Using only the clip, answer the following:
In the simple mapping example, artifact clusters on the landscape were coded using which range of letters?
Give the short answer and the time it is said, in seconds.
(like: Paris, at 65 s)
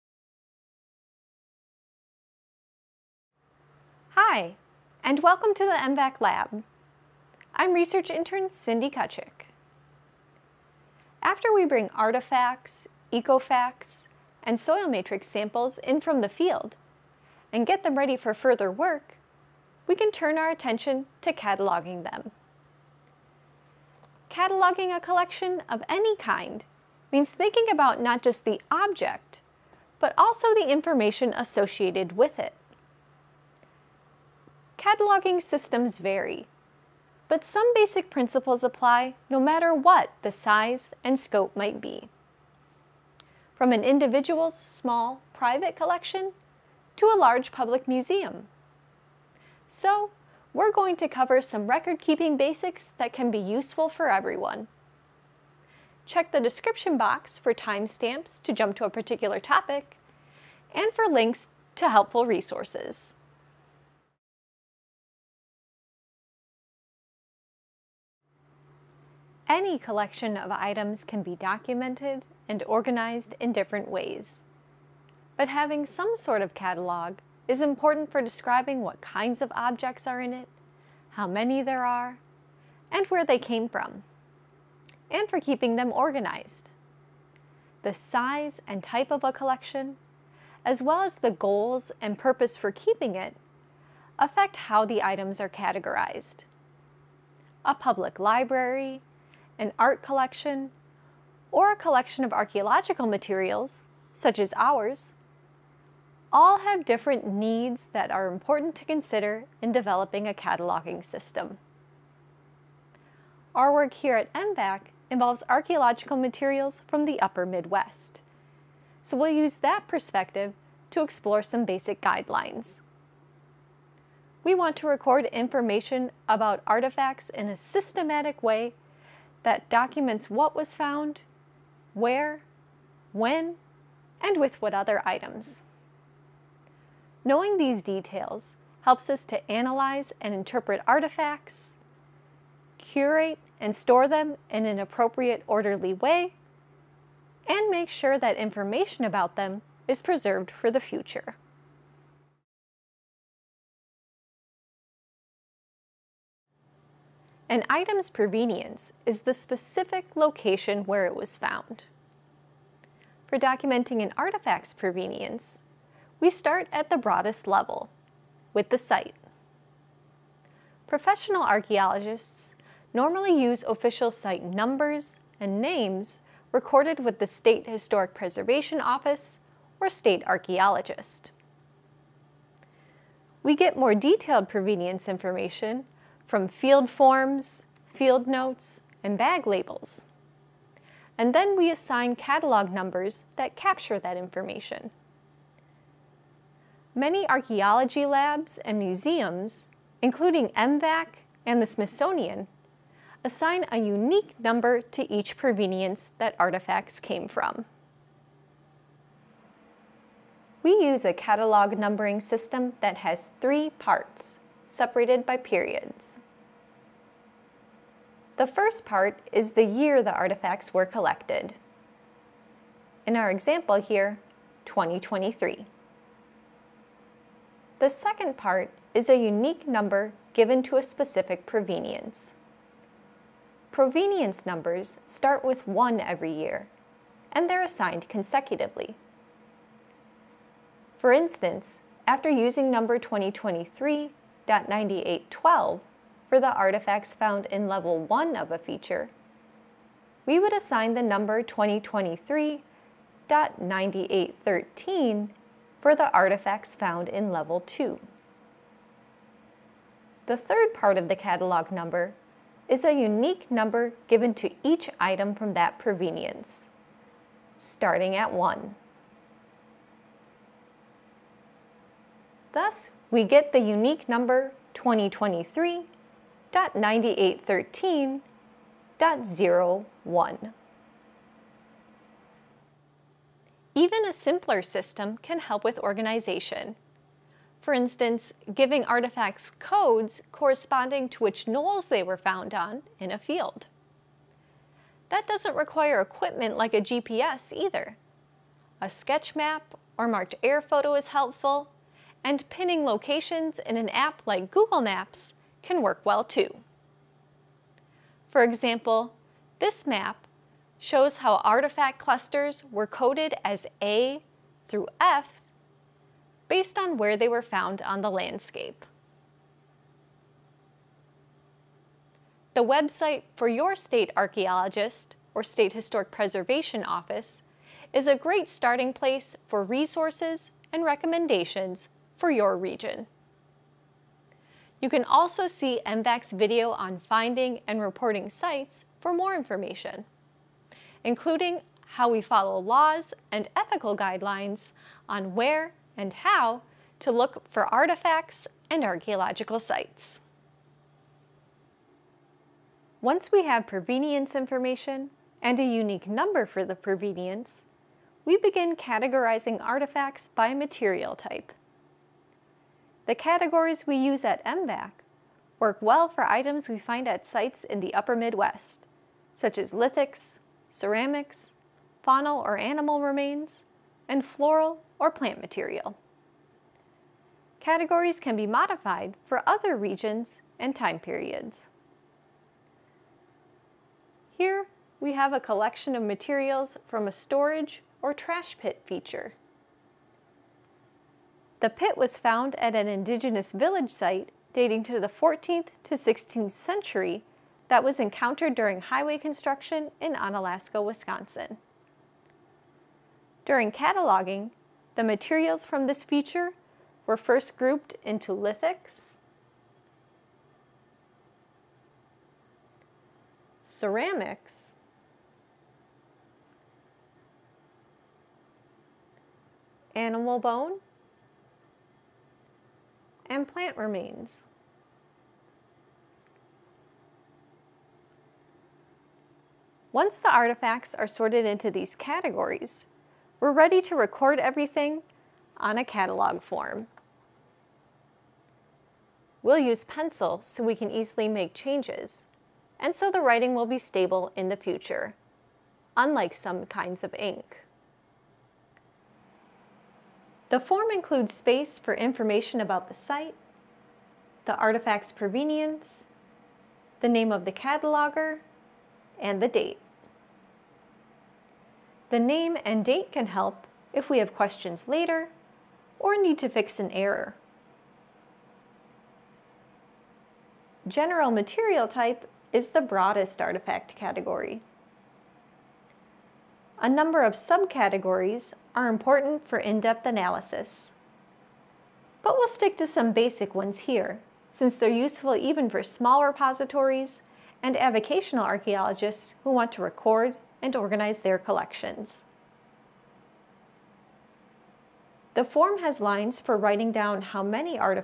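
A through F, at 313 s.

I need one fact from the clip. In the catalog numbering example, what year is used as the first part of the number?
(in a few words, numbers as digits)
2023.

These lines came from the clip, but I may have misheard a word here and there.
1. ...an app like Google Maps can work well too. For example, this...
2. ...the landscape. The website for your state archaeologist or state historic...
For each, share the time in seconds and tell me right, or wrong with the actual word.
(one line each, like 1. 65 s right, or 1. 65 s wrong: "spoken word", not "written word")
1. 303 s right
2. 318 s right.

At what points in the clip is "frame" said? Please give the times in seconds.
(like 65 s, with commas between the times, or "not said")
not said.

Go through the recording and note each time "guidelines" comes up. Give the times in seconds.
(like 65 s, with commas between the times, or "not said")
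122 s, 343 s.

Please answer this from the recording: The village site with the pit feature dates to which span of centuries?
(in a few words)
14th to 16th century.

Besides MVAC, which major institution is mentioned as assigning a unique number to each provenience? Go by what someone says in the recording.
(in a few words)
the Smithsonian.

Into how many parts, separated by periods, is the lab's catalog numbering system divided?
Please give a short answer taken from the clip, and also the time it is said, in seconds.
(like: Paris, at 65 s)
3, at 213 s.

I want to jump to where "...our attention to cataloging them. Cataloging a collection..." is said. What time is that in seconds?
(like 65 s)
20 s.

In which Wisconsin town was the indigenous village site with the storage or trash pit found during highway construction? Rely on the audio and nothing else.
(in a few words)
Onalaska.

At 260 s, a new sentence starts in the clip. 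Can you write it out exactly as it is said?
The third part of the catalog number is a unique number given to each item from that provenience, starting at 1.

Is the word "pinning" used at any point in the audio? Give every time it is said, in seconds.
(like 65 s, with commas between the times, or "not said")
302 s.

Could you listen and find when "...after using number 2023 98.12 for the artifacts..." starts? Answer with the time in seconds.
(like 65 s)
242 s.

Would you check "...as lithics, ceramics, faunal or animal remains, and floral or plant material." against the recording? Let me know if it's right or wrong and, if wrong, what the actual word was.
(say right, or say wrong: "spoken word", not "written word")
right.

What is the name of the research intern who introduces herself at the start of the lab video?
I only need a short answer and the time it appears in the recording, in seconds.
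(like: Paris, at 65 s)
Cindy Kocik, at 8 s.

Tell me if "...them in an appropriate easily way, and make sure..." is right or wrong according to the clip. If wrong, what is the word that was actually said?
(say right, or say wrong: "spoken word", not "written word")
wrong: "orderly", not "easily".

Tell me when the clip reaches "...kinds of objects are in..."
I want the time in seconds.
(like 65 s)
79 s.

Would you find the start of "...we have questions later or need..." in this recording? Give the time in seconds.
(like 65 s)
464 s.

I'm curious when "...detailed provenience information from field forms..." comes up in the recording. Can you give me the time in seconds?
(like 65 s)
183 s.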